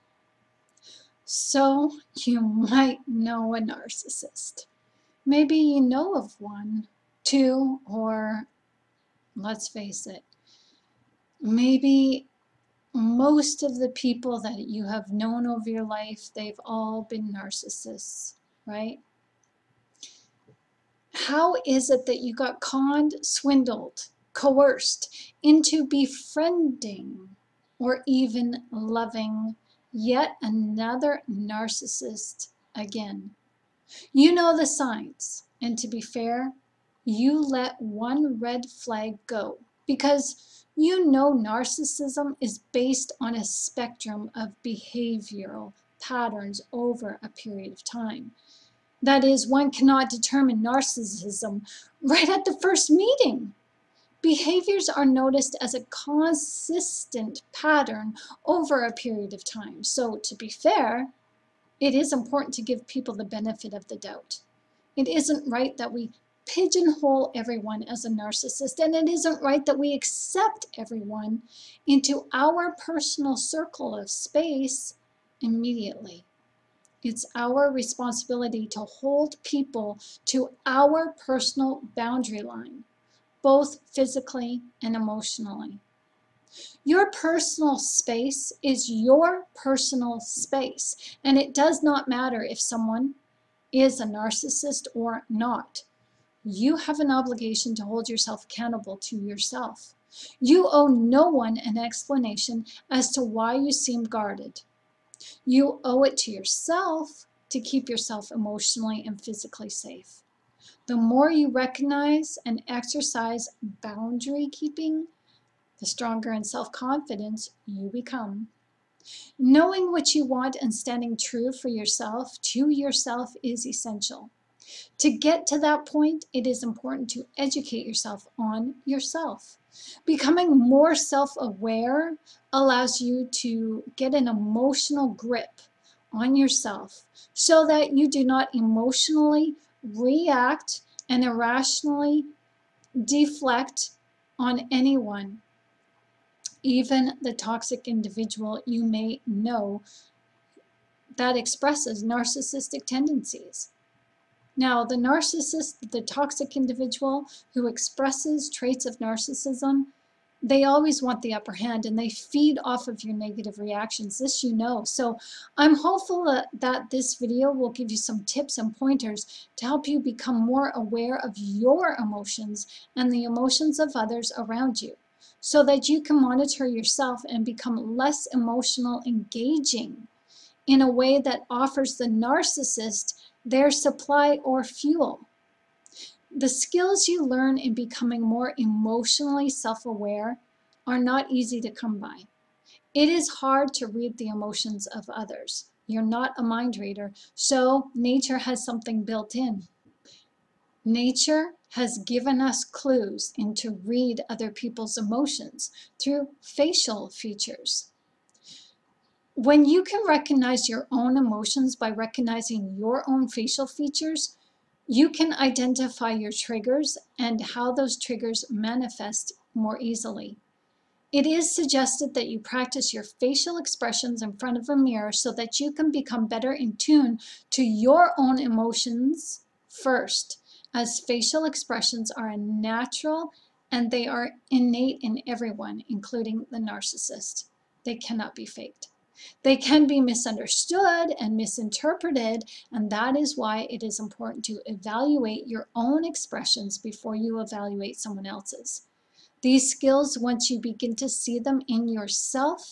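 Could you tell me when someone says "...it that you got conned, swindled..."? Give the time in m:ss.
0:21.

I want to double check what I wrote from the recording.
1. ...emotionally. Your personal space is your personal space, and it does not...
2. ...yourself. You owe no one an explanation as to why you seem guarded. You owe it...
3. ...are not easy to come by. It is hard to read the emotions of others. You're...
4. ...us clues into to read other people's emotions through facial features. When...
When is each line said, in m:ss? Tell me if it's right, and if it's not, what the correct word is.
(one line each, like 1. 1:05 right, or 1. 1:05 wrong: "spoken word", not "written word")
1. 1:24 right
2. 1:39 right
3. 3:10 right
4. 3:22 right.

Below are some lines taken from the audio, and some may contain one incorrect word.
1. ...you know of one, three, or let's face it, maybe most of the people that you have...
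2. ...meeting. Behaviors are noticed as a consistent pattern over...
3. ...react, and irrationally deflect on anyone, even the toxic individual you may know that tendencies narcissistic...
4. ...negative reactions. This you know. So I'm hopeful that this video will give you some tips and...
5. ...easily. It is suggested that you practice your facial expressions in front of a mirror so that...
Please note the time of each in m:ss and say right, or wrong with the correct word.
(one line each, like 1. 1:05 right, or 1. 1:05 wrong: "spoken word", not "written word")
1. 0:05 wrong: "two", not "three"
2. 0:52 right
3. 2:19 wrong: "expresses", not "tendencies"
4. 2:43 right
5. 3:39 right.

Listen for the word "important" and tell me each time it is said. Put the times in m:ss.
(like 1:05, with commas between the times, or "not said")
1:02, 2:06, 4:03.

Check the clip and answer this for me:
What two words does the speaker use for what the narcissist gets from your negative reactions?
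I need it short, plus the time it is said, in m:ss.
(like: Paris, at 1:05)
supply or fuel, at 3:03.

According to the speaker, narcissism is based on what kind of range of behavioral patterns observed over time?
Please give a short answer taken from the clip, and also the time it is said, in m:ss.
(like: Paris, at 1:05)
spectrum, at 0:43.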